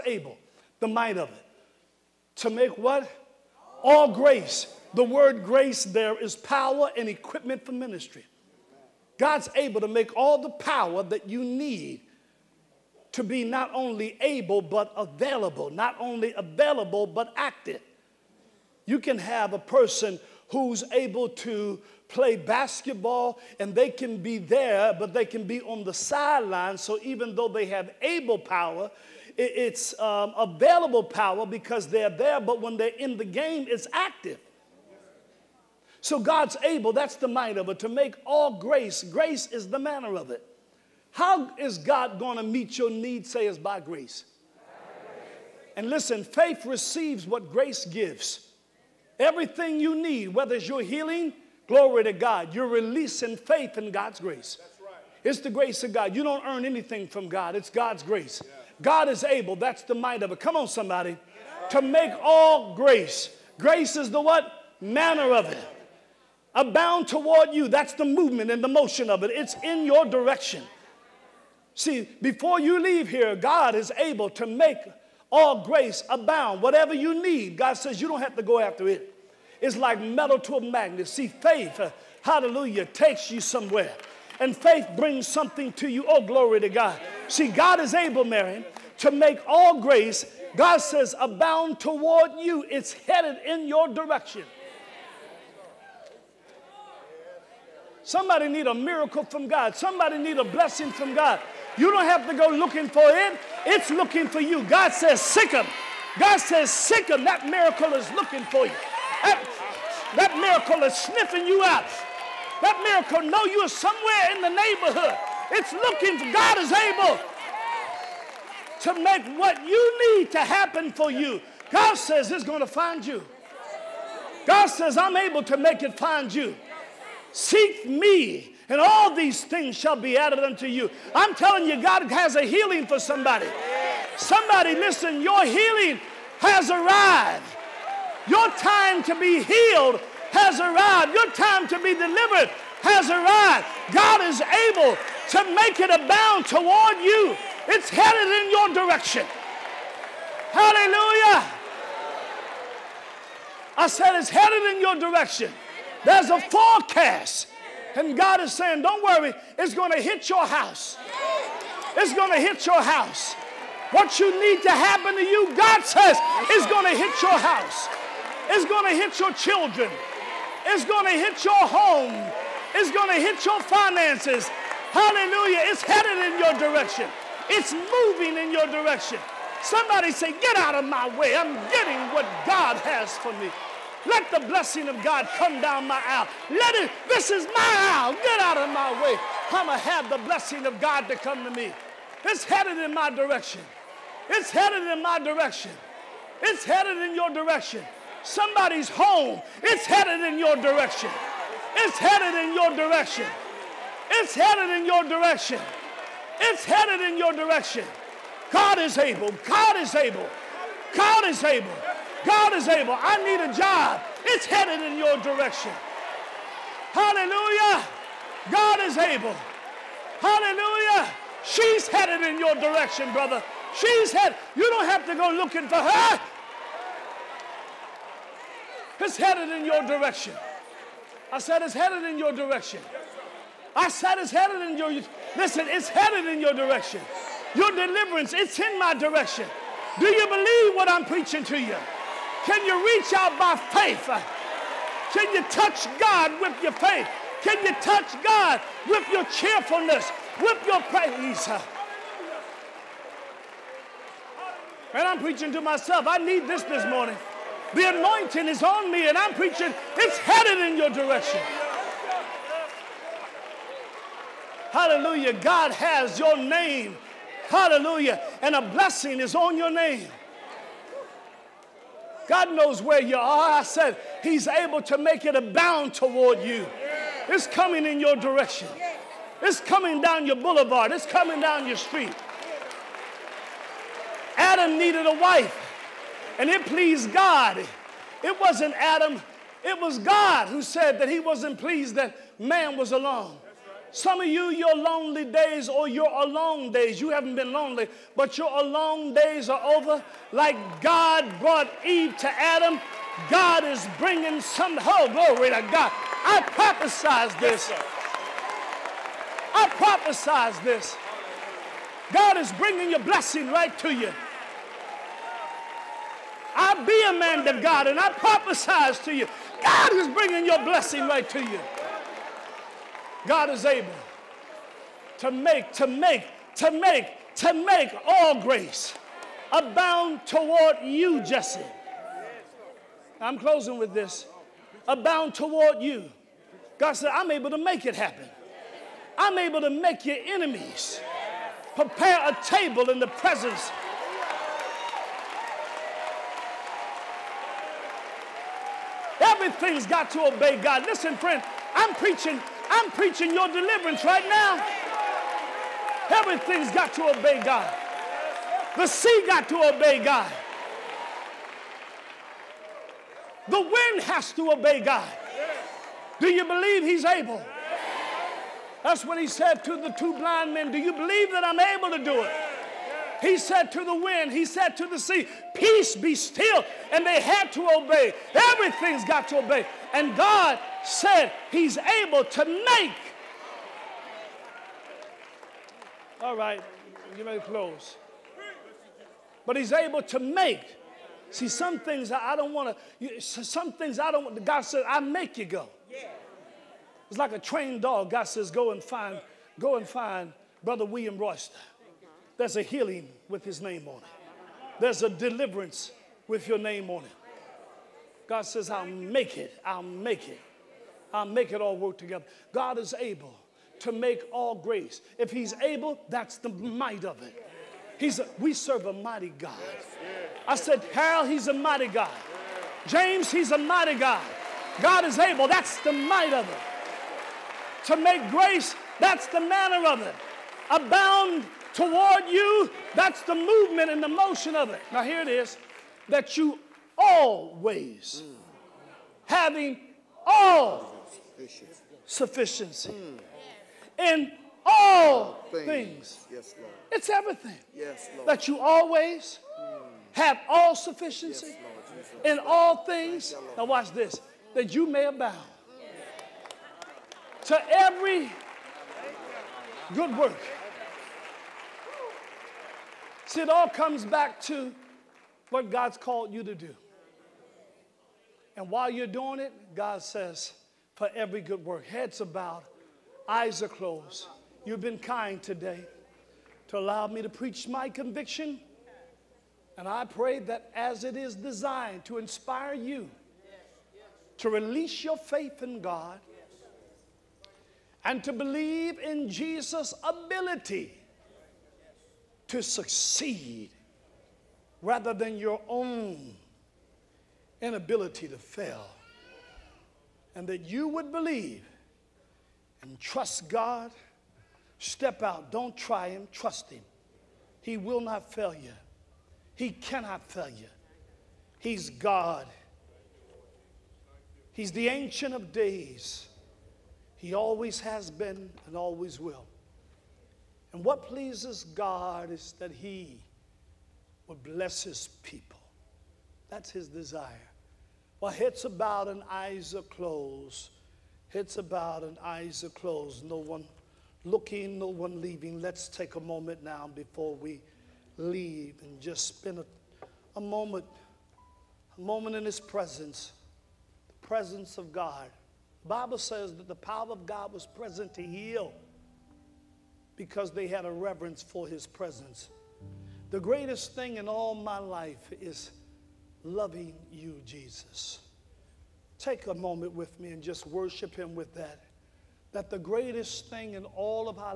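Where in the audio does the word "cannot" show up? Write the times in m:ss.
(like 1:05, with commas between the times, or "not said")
8:29.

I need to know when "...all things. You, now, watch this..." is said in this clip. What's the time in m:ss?
7:32.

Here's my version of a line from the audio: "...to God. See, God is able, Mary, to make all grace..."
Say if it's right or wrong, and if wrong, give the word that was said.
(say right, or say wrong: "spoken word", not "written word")
right.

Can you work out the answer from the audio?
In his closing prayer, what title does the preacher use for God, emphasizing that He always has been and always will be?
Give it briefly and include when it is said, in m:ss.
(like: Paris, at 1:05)
Ancient of Days, at 8:34.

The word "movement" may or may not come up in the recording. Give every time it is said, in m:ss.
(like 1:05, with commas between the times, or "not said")
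1:08, 7:13.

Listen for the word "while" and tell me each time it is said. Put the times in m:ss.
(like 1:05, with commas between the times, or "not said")
7:48, 8:48.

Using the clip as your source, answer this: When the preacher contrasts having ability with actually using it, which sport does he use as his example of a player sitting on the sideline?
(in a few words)
Basketball.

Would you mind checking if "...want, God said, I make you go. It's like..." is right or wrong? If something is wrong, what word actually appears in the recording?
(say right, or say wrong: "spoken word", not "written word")
right.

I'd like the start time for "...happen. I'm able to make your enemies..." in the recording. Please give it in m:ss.
5:37.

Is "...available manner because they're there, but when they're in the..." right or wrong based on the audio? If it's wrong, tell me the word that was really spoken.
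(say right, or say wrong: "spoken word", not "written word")
wrong: "power", not "manner".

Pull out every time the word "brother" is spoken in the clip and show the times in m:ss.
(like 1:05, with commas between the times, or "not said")
3:43, 6:40.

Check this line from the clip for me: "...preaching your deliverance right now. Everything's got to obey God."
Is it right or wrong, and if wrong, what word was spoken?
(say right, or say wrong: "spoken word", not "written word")
right.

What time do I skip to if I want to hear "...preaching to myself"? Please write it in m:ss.
4:15.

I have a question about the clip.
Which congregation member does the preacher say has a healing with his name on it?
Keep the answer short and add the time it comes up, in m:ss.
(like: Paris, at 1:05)
William Royster, at 6:40.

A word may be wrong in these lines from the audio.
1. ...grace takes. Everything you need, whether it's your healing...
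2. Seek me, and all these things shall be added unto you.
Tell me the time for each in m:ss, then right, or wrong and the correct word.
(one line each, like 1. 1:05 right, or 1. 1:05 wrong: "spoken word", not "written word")
1. 0:47 wrong: "gives", not "takes"
2. 2:07 right.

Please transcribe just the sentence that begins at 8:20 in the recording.
And that you would believe and trust God.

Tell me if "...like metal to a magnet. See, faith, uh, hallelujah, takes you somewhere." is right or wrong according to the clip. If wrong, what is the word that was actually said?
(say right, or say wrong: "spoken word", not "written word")
right.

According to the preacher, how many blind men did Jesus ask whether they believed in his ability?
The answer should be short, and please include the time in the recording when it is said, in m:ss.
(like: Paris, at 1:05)
2, at 6:09.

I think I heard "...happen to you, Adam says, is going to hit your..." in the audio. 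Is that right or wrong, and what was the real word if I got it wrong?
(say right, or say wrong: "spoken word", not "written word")
wrong: "God", not "Adam".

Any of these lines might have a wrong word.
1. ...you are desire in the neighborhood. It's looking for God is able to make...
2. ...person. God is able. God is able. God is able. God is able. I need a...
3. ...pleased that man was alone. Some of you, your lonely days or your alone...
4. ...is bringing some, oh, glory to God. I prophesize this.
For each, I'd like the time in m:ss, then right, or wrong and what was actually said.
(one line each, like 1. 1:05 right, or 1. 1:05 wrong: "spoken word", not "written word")
1. 1:53 wrong: "somewhere", not "desire"
2. 3:27 wrong: "direction", not "person"
3. 4:51 right
4. 5:03 right.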